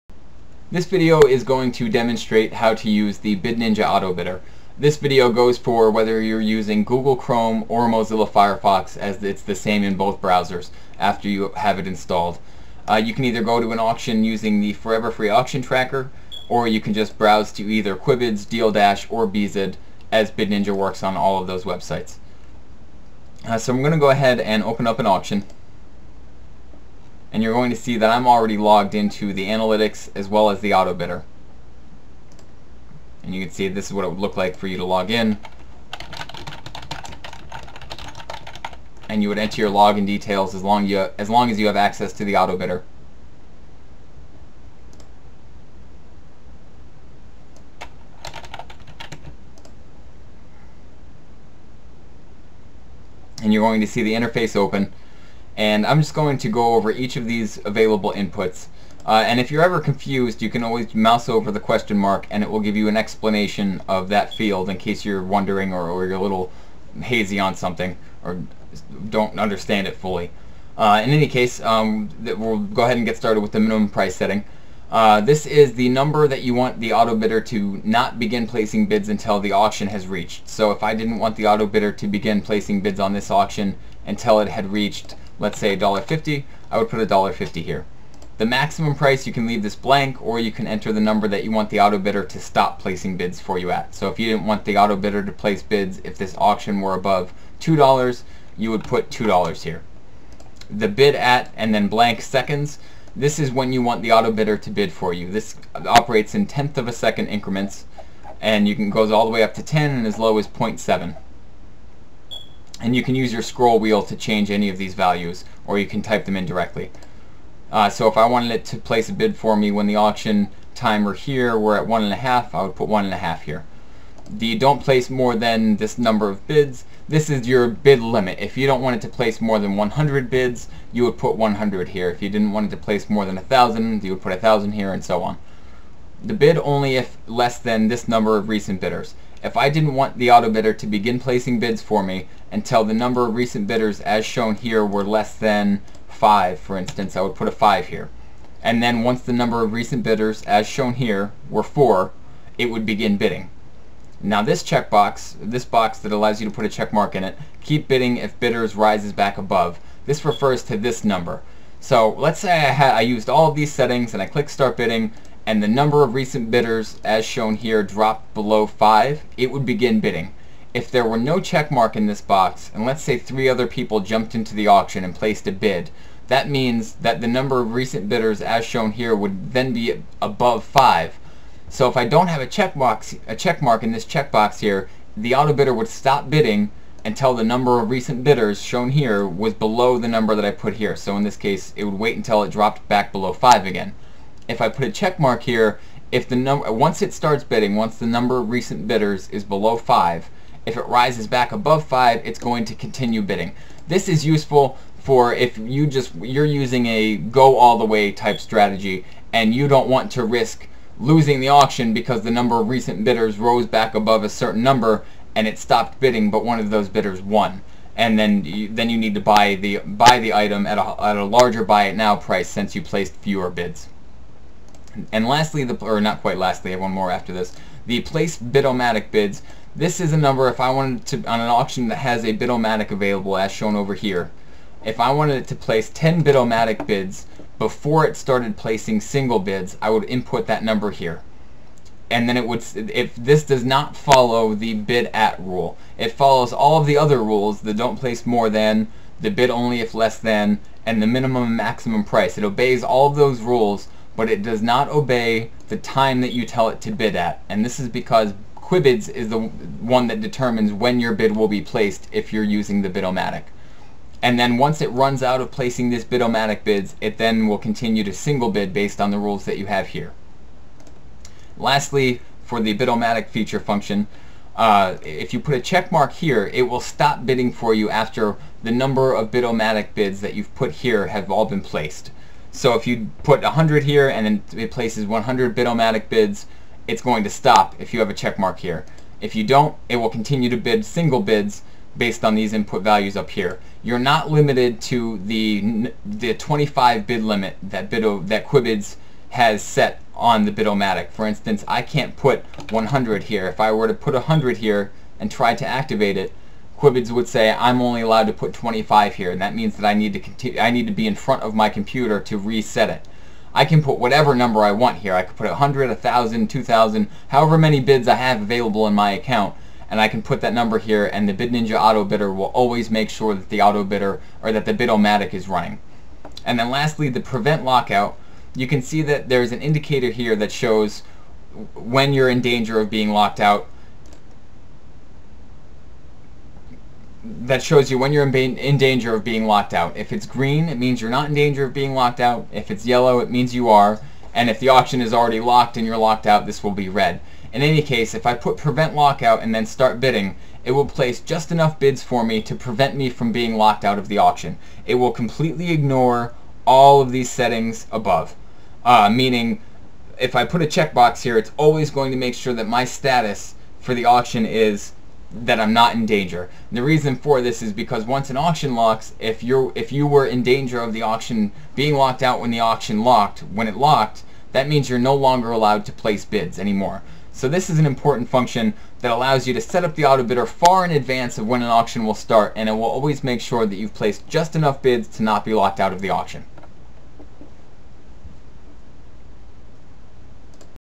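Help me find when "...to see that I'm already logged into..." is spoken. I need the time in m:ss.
0:27.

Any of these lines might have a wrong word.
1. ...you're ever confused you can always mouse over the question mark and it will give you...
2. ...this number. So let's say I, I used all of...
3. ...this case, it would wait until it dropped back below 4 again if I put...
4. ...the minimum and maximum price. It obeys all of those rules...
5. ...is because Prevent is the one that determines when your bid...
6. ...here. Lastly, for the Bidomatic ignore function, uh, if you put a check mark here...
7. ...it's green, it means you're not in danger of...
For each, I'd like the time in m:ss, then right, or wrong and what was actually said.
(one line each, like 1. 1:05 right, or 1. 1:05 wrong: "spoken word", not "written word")
1. 0:59 right
2. 2:40 right
3. 3:11 wrong: "5", not "4"
4. 4:11 right
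5. 4:17 wrong: "Quibids", not "Prevent"
6. 4:29 wrong: "feature", not "ignore"
7. 5:40 right.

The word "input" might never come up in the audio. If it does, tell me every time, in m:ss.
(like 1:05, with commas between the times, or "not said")
0:58, 4:00, 4:52.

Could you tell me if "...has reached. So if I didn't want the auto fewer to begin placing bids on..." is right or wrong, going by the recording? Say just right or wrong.
wrong.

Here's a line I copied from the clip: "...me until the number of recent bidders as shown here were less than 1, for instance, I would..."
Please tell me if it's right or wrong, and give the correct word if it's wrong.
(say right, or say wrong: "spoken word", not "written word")
wrong: "5", not "1".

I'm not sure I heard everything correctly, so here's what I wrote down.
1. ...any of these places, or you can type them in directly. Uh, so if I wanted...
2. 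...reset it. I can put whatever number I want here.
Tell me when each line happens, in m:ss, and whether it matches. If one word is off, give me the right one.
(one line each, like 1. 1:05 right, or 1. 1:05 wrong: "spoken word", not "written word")
1. 1:54 wrong: "values", not "places"
2. 5:12 right.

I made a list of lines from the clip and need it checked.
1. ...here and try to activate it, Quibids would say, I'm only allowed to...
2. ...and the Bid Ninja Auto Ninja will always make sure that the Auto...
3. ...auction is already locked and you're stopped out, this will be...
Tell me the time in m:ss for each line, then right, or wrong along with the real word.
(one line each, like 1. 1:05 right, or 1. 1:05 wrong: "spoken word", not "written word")
1. 5:04 right
2. 5:21 wrong: "Bidder", not "Ninja"
3. 5:44 wrong: "locked", not "stopped".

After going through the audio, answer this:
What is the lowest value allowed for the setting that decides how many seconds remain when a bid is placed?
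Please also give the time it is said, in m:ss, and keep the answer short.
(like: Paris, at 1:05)
0.7, at 1:50.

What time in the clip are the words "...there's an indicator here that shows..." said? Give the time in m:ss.
5:29.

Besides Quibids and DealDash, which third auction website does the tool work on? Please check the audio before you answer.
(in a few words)
Beezid.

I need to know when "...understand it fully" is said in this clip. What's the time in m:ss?
1:09.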